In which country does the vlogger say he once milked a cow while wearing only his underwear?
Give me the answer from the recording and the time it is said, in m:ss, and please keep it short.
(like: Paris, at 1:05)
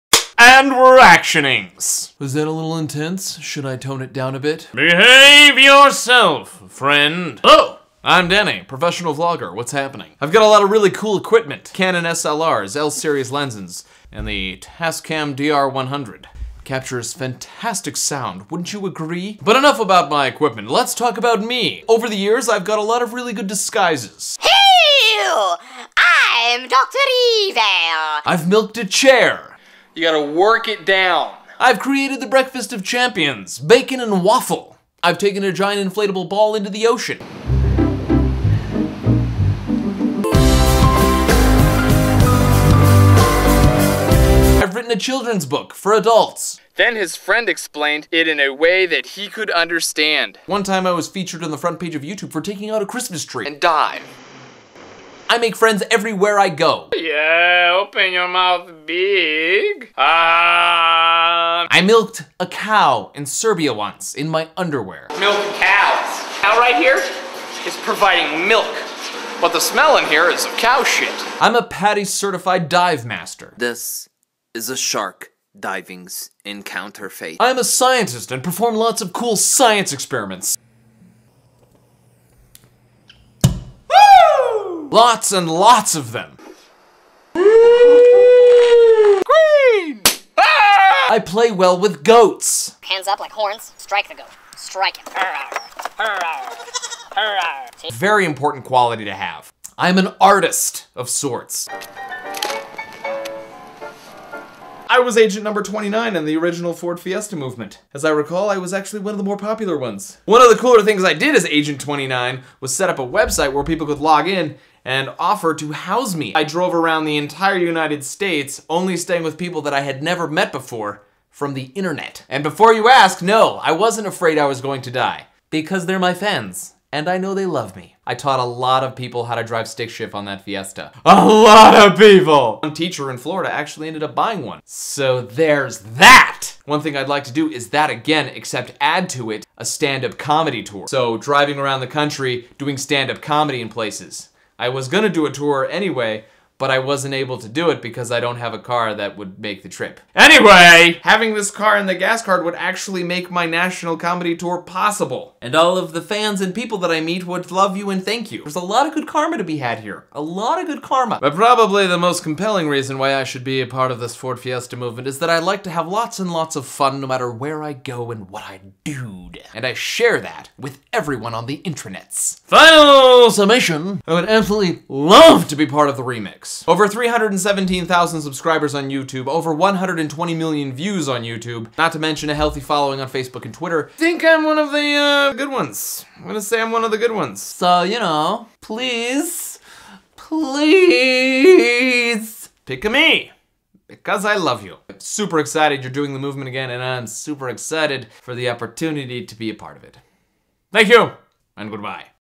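Serbia, at 1:03.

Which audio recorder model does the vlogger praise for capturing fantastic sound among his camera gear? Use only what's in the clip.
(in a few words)
Tascam DR100.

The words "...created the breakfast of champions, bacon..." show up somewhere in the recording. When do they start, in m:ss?
0:31.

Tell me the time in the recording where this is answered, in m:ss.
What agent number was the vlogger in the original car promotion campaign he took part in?
1:45.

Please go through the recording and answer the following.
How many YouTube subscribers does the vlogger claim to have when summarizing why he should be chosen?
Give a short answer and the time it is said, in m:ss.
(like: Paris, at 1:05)
Over 317,000, at 2:56.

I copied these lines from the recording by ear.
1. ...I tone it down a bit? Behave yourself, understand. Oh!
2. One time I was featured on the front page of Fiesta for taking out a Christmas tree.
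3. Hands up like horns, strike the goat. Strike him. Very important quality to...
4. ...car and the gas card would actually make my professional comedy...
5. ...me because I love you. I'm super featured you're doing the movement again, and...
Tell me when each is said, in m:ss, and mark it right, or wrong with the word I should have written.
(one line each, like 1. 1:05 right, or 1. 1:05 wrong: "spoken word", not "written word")
1. 0:03 wrong: "friend", not "understand"
2. 0:50 wrong: "YouTube", not "Fiesta"
3. 1:32 right
4. 2:31 wrong: "national", not "professional"
5. 3:12 wrong: "excited", not "featured".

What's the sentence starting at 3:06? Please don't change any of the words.
I'm gonna say I'm one of the good ones.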